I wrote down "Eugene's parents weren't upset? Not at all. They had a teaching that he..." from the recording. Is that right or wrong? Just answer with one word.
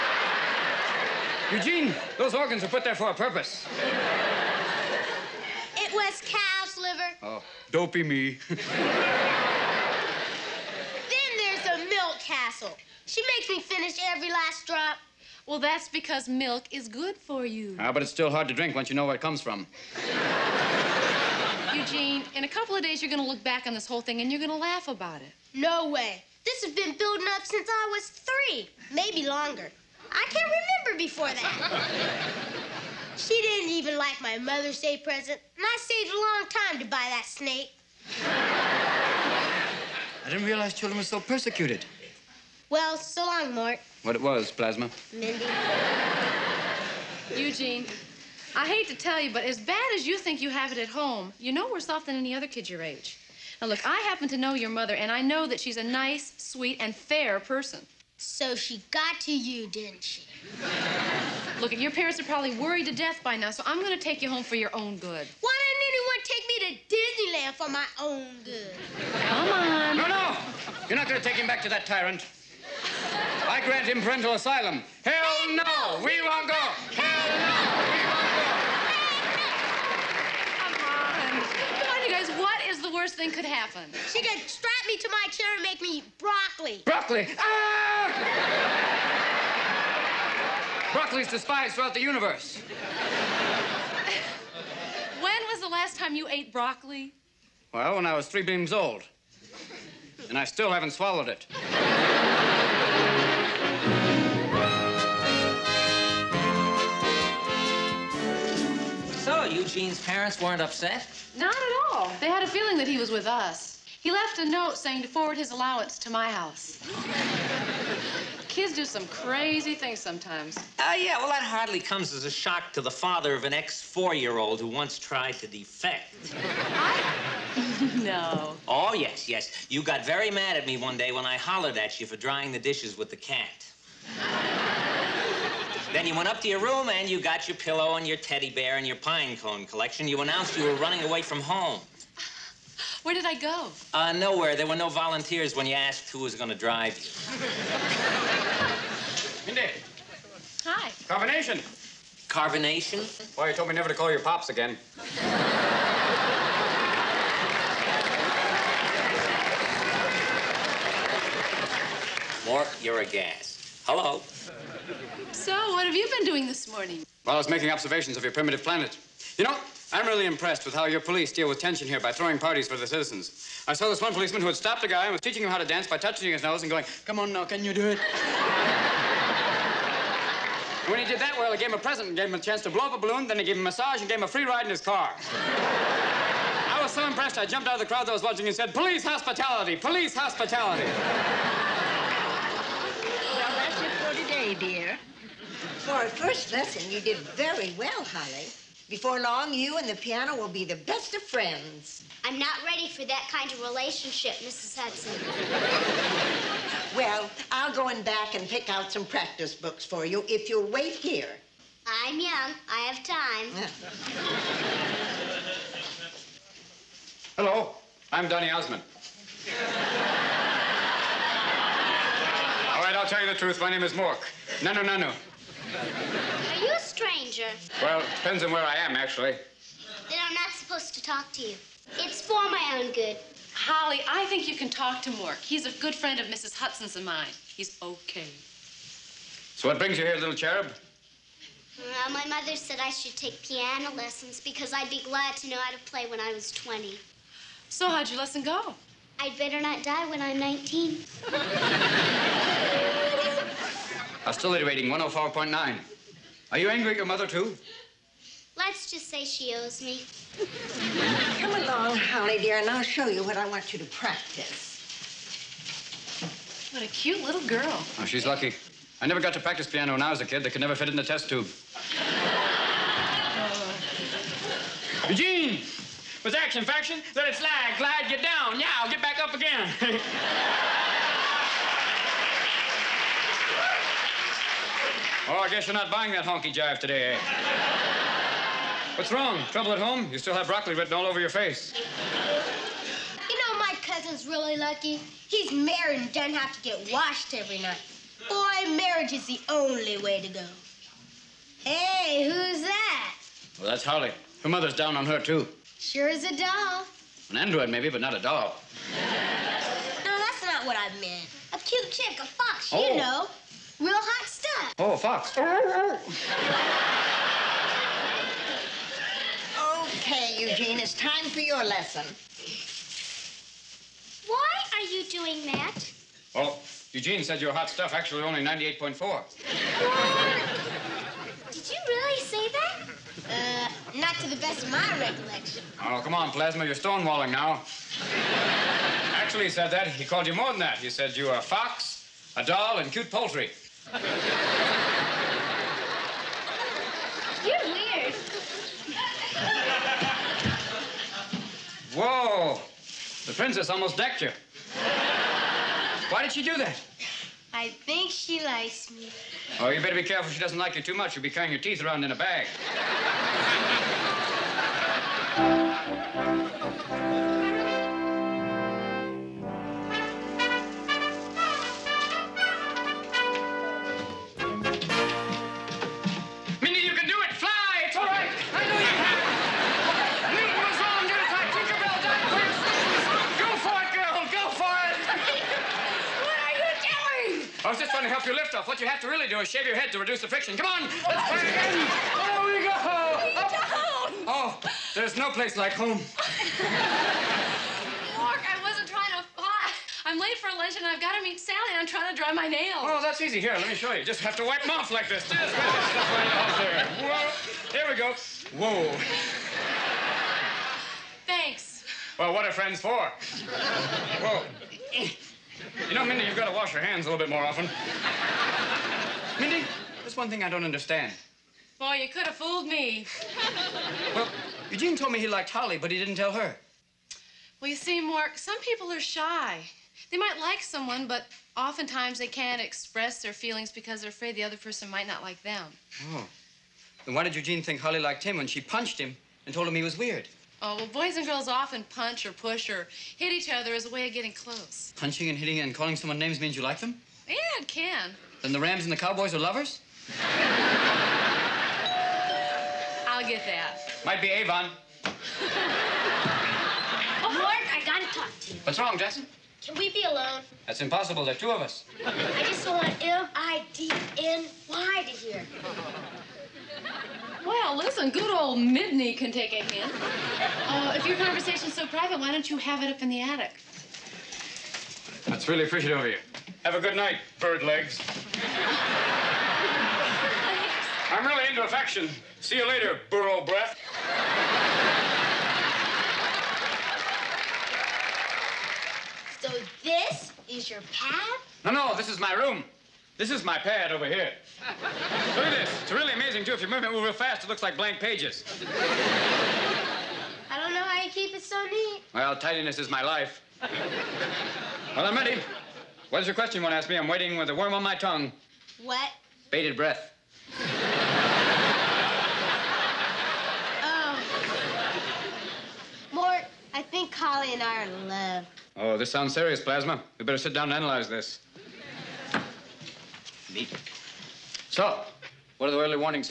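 wrong.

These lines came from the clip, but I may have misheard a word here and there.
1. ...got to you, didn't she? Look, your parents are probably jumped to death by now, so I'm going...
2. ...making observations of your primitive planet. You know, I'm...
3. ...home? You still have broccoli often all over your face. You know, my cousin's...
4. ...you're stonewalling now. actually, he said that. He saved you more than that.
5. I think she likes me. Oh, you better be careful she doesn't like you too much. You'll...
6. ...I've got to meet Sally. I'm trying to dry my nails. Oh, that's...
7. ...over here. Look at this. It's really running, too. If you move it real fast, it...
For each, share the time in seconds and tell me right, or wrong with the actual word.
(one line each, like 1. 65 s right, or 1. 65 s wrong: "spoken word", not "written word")
1. 58 s wrong: "worried", not "jumped"
2. 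167 s right
3. 289 s wrong: "written", not "often"
4. 336 s wrong: "called", not "saved"
5. 357 s right
6. 400 s right
7. 493 s wrong: "amazing", not "running".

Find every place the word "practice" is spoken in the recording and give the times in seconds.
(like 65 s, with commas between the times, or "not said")
209 s, 263 s, 269 s.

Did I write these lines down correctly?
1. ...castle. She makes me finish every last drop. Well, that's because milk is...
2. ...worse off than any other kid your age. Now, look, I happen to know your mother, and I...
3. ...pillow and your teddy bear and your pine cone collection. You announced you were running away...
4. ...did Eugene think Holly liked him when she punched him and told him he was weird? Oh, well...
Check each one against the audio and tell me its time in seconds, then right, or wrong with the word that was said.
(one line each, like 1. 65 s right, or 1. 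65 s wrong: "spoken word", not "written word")
1. 12 s right
2. 51 s right
3. 137 s right
4. 437 s right.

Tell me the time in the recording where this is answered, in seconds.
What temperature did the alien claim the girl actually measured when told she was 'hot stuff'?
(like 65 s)
328 s.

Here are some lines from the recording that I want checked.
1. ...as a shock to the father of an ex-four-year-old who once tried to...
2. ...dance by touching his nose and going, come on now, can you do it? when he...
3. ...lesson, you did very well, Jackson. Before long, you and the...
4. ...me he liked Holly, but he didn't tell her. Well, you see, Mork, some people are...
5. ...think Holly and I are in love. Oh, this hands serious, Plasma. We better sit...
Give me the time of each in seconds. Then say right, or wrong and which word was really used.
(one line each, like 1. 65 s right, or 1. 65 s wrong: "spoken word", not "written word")
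1. 122 s right
2. 175 s right
3. 196 s wrong: "Holly", not "Jackson"
4. 425 s right
5. 516 s wrong: "sounds", not "hands".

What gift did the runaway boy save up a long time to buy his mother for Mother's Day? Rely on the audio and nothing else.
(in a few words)
snake.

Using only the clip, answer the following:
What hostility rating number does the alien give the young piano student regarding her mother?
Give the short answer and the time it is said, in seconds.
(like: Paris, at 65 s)
104.9, at 254 s.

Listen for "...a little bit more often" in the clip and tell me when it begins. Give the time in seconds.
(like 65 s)
417 s.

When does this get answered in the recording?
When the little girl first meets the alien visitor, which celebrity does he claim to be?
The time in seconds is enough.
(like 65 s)
218 s.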